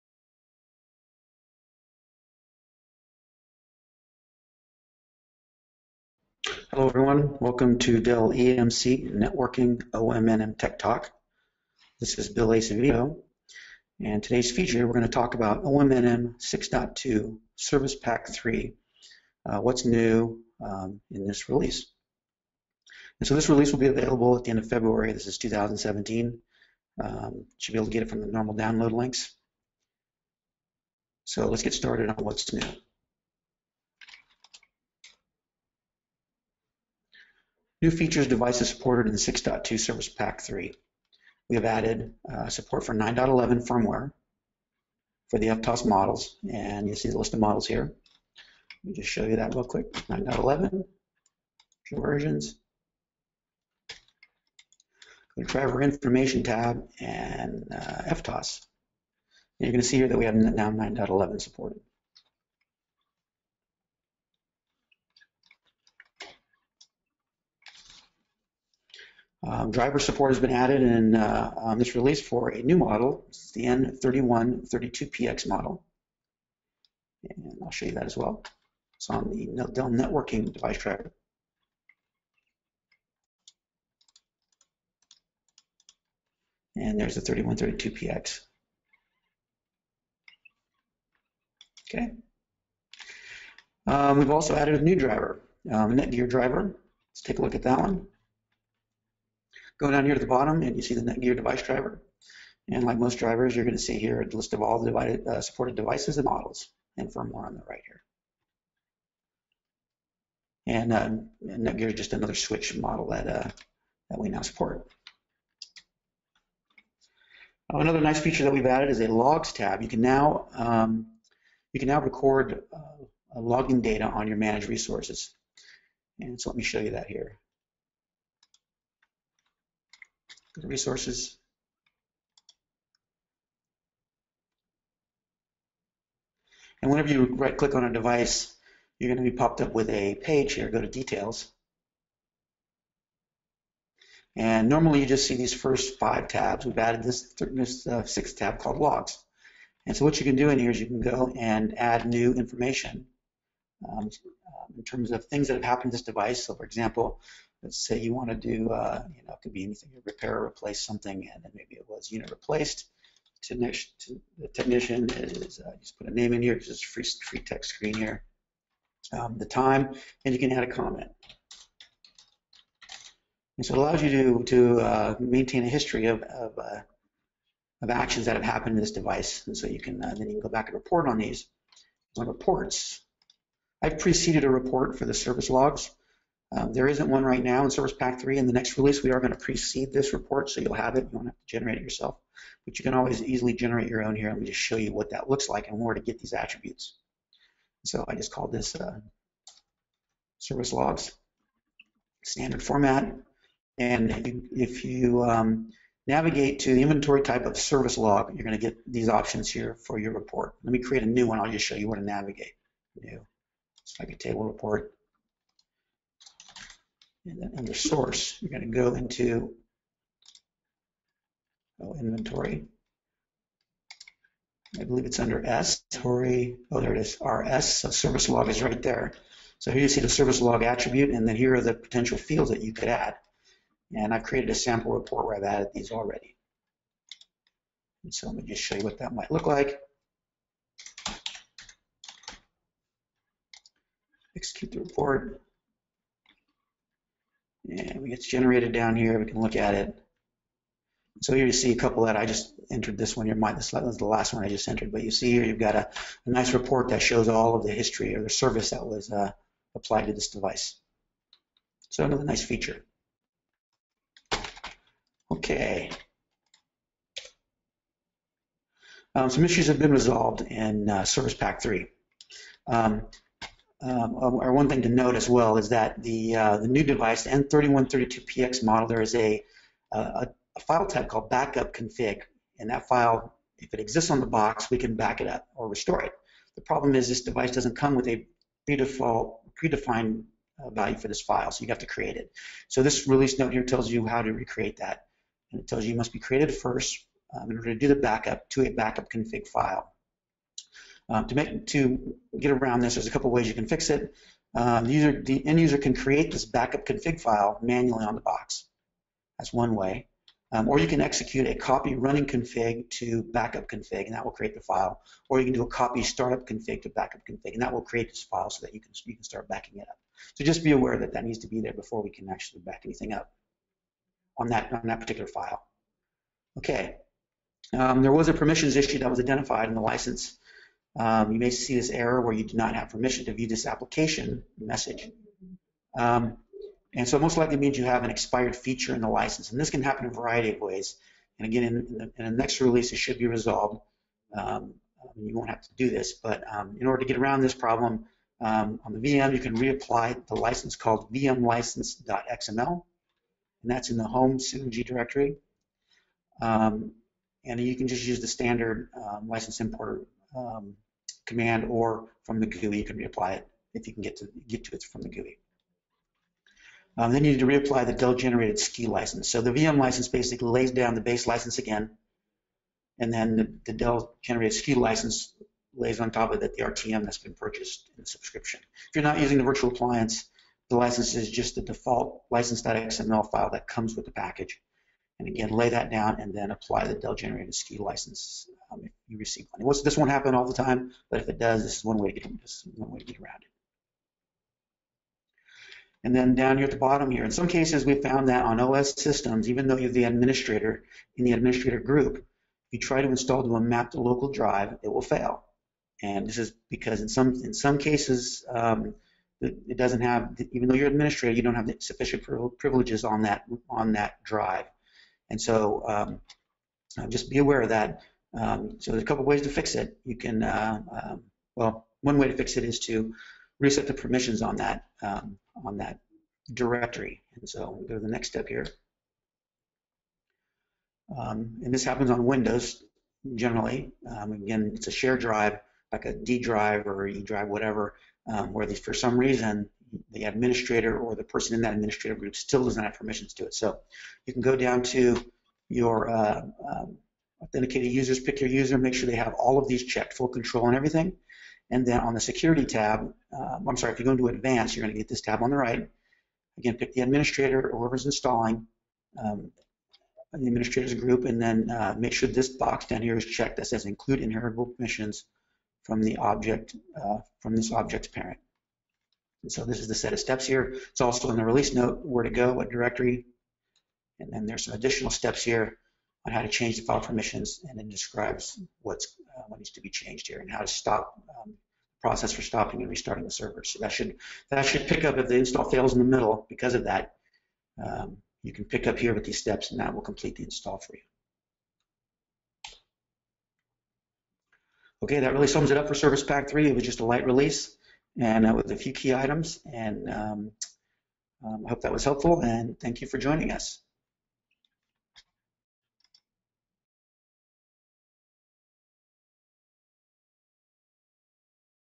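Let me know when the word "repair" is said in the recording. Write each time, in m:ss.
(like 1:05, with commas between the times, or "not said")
2:40.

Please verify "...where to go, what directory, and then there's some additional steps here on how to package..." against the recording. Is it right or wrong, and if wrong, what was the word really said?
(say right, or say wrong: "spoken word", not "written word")
wrong: "change", not "package".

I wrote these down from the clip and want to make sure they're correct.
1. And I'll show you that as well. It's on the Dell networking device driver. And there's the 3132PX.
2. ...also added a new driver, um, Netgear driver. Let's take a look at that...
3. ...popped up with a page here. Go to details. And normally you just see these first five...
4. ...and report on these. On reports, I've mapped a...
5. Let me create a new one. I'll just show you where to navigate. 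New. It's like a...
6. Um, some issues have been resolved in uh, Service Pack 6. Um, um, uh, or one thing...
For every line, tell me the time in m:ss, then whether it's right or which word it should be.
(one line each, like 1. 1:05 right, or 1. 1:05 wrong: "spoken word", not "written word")
1. 1:17 right
2. 1:34 right
3. 2:19 right
4. 3:00 wrong: "preceded", not "mapped"
5. 3:30 right
6. 4:29 wrong: "3", not "6".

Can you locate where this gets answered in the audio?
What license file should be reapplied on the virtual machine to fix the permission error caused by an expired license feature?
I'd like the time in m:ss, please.
5:51.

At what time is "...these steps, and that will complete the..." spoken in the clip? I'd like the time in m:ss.
8:09.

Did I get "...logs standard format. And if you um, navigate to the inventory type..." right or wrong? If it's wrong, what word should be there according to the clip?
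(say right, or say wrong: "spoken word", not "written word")
right.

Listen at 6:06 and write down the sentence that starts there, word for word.
Um, then you need to reapply the Dell generated SKU license.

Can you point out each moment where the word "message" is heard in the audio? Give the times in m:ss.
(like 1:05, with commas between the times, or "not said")
5:34.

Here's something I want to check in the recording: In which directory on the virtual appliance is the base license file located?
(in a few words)
home Synergy directory.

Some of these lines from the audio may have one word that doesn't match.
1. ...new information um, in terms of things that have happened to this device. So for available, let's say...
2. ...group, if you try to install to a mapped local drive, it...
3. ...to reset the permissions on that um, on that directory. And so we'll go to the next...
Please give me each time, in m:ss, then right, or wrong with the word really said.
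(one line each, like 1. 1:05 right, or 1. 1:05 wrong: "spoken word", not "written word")
1. 2:32 wrong: "example", not "available"
2. 6:41 right
3. 7:02 right.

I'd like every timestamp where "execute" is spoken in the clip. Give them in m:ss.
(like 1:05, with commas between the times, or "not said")
4:04, 5:11.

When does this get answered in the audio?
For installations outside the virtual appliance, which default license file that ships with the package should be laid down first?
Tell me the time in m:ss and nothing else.
6:22.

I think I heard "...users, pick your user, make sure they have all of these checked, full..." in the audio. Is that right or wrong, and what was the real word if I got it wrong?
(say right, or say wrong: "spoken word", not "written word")
right.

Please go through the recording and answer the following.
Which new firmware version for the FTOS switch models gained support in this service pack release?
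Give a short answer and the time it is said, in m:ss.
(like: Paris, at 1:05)
9.11, at 0:42.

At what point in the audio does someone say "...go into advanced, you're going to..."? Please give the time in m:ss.
7:34.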